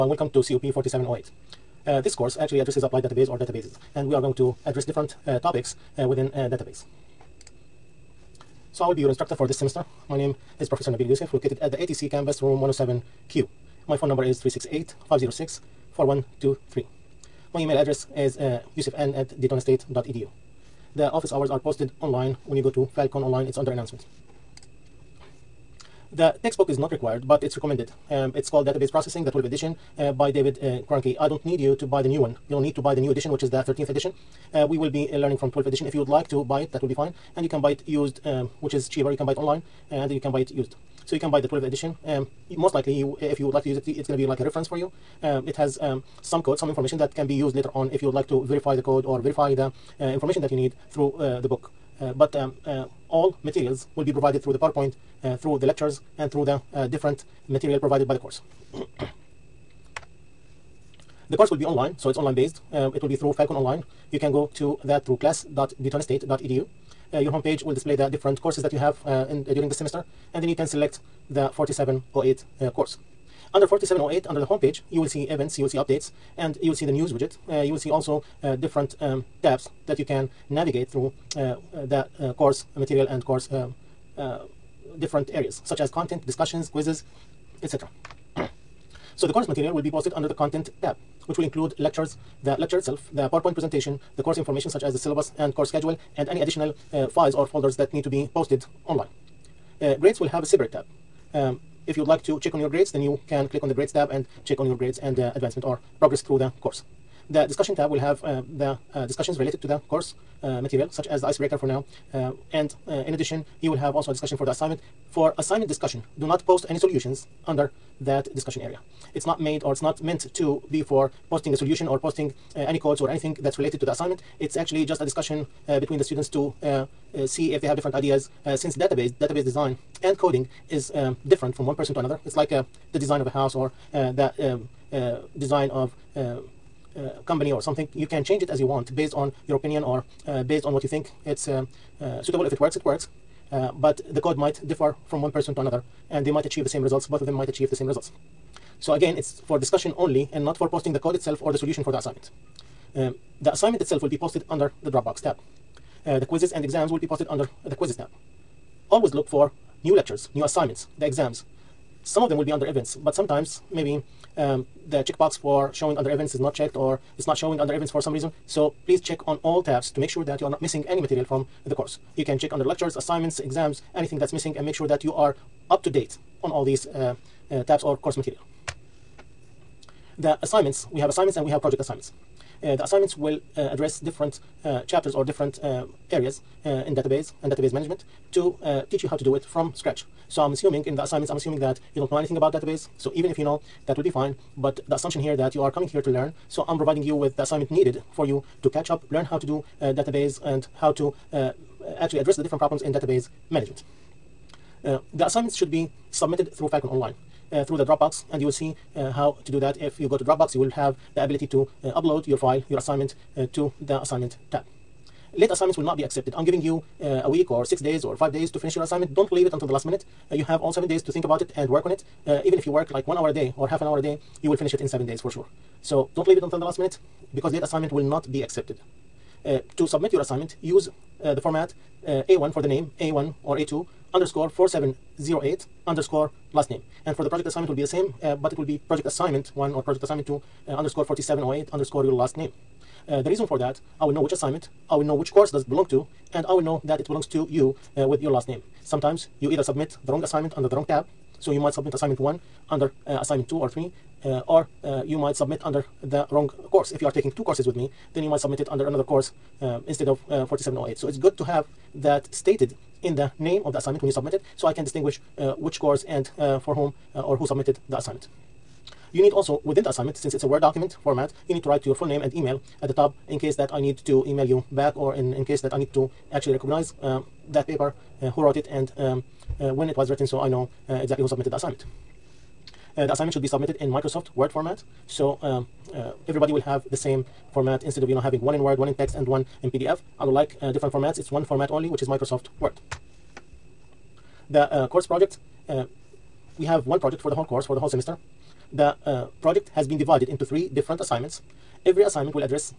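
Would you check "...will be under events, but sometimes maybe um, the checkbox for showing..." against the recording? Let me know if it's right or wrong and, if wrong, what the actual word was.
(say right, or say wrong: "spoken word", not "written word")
right.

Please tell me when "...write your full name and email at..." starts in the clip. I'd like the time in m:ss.
4:31.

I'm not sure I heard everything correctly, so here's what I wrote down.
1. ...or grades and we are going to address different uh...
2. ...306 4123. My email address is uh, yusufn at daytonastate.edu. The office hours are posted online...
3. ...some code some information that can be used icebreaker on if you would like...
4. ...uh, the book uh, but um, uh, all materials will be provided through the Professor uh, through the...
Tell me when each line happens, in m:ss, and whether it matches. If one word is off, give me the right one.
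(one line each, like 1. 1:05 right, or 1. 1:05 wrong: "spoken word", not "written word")
1. 0:03 wrong: "databases", not "grades"
2. 0:15 wrong: "506", not "306"
3. 0:46 wrong: "later", not "icebreaker"
4. 0:51 wrong: "PowerPoint", not "Professor".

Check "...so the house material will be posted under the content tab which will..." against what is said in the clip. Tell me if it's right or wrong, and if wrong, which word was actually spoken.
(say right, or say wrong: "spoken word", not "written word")
wrong: "course", not "house".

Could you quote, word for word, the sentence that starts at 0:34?
Uh, we will be uh, learning from 12th edition.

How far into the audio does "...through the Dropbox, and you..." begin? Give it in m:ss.
3:27.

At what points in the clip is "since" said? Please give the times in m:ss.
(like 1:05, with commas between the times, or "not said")
2:08, 4:30.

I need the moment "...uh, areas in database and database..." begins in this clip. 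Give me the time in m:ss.
3:05.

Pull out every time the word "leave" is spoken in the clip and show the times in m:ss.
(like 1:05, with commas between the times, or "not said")
3:39, 3:46.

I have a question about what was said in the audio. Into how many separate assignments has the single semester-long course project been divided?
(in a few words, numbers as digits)
3.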